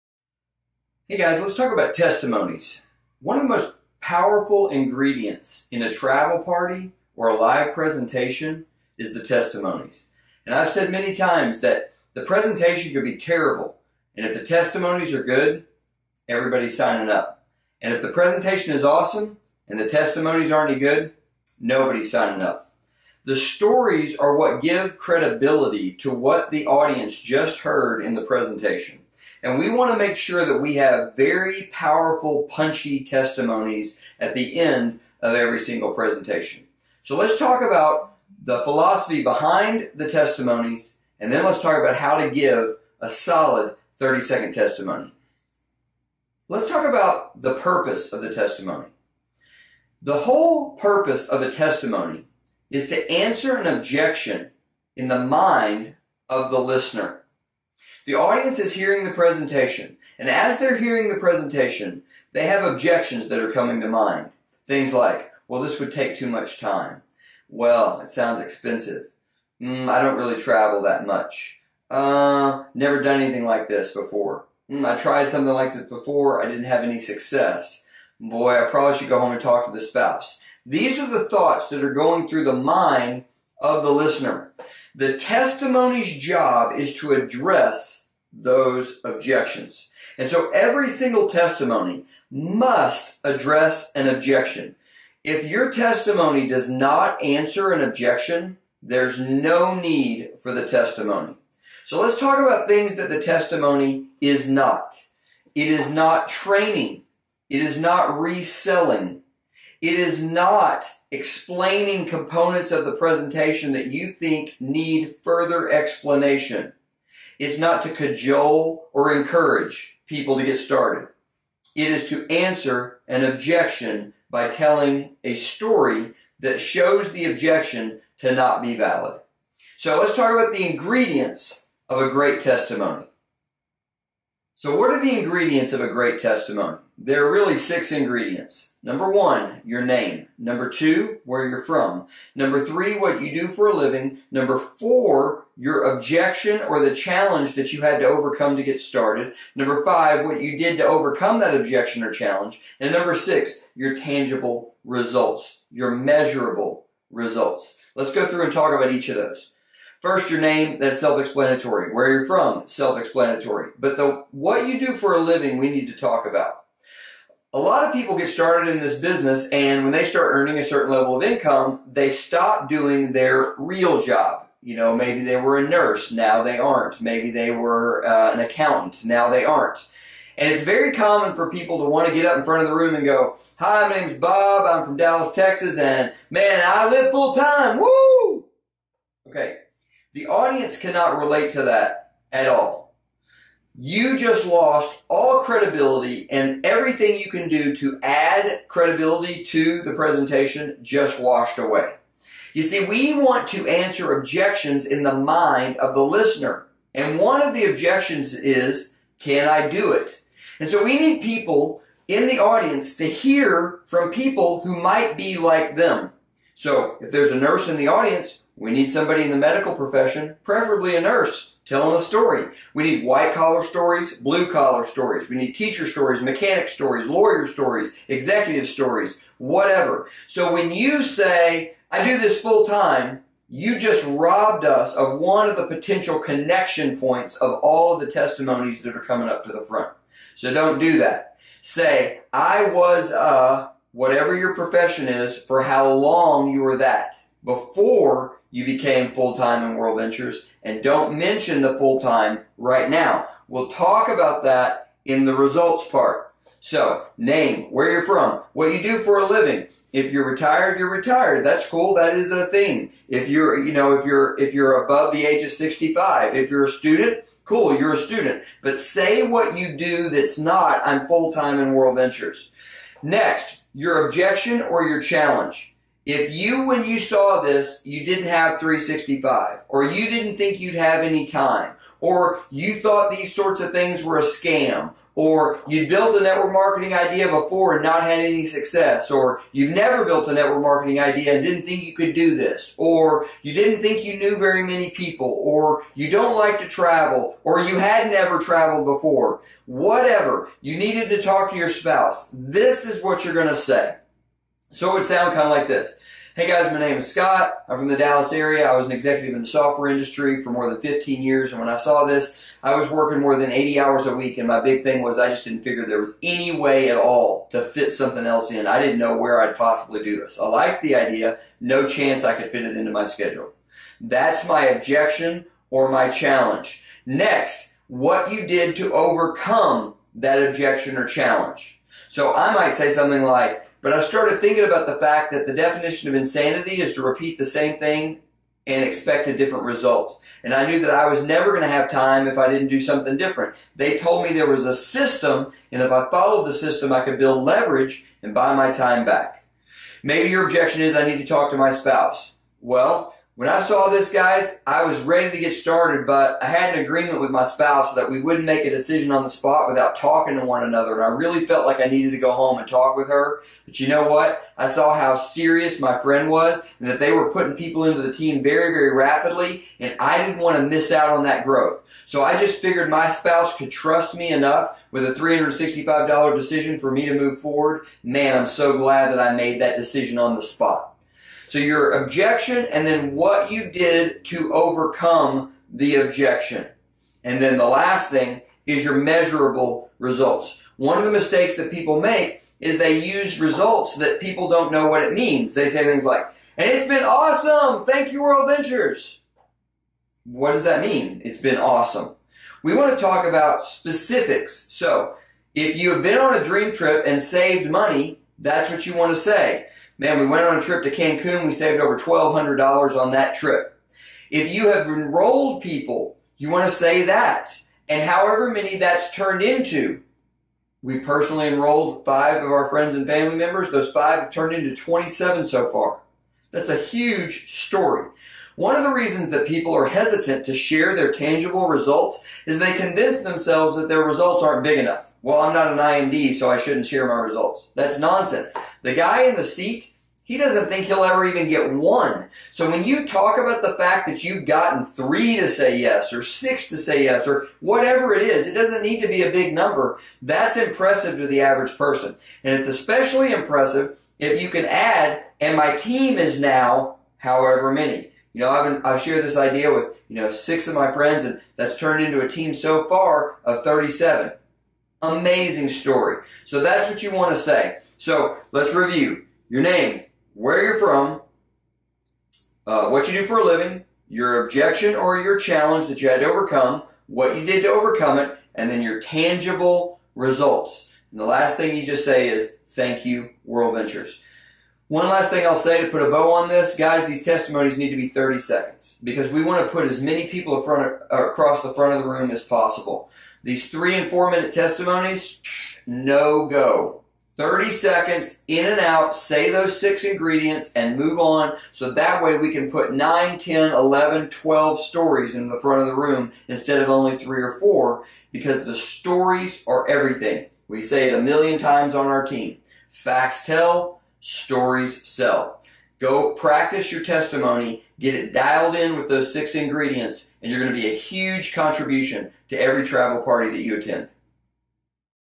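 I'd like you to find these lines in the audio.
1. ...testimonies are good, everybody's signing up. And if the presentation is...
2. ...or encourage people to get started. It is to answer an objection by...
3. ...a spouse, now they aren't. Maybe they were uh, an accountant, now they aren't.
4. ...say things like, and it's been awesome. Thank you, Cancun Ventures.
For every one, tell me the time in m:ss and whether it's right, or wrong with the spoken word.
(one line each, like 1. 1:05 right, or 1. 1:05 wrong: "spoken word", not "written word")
1. 0:14 right
2. 1:58 right
3. 2:55 wrong: "nurse", not "spouse"
4. 6:35 wrong: "World", not "Cancun".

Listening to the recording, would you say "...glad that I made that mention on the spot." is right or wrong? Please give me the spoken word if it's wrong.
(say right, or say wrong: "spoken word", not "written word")
wrong: "decision", not "mention".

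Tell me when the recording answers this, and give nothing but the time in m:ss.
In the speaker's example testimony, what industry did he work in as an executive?
5:09.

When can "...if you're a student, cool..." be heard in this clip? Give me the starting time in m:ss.
4:26.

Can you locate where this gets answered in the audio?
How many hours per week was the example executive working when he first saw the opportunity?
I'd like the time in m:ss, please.
5:13.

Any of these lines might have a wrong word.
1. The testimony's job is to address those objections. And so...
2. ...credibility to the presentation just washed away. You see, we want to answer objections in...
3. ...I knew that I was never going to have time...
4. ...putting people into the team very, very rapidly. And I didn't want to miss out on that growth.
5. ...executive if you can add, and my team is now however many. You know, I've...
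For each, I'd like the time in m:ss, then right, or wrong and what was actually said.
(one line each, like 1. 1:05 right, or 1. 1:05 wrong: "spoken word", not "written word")
1. 1:24 right
2. 3:18 right
3. 5:40 right
4. 6:07 right
5. 7:33 wrong: "impressive", not "executive".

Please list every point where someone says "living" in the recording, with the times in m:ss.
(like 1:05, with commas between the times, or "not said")
2:23, 2:45, 4:19, 7:53.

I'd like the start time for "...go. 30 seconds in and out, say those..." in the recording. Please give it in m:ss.
8:16.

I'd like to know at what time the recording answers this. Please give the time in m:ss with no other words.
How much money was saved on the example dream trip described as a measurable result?
6:51.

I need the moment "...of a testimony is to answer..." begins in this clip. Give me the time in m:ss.
0:51.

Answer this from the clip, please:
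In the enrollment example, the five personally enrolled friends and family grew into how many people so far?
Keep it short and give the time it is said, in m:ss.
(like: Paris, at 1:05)
27, at 7:04.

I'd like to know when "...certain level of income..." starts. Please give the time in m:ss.
2:50.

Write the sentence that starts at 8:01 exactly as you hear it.
And the last thing you just say is, thank you, World Ventures.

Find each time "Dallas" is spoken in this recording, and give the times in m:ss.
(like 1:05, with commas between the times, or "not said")
3:04, 5:07.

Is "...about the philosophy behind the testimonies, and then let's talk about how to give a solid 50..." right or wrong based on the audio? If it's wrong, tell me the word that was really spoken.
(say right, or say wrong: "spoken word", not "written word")
wrong: "30", not "50".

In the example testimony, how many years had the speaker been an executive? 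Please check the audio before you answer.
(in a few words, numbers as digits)
more than 15.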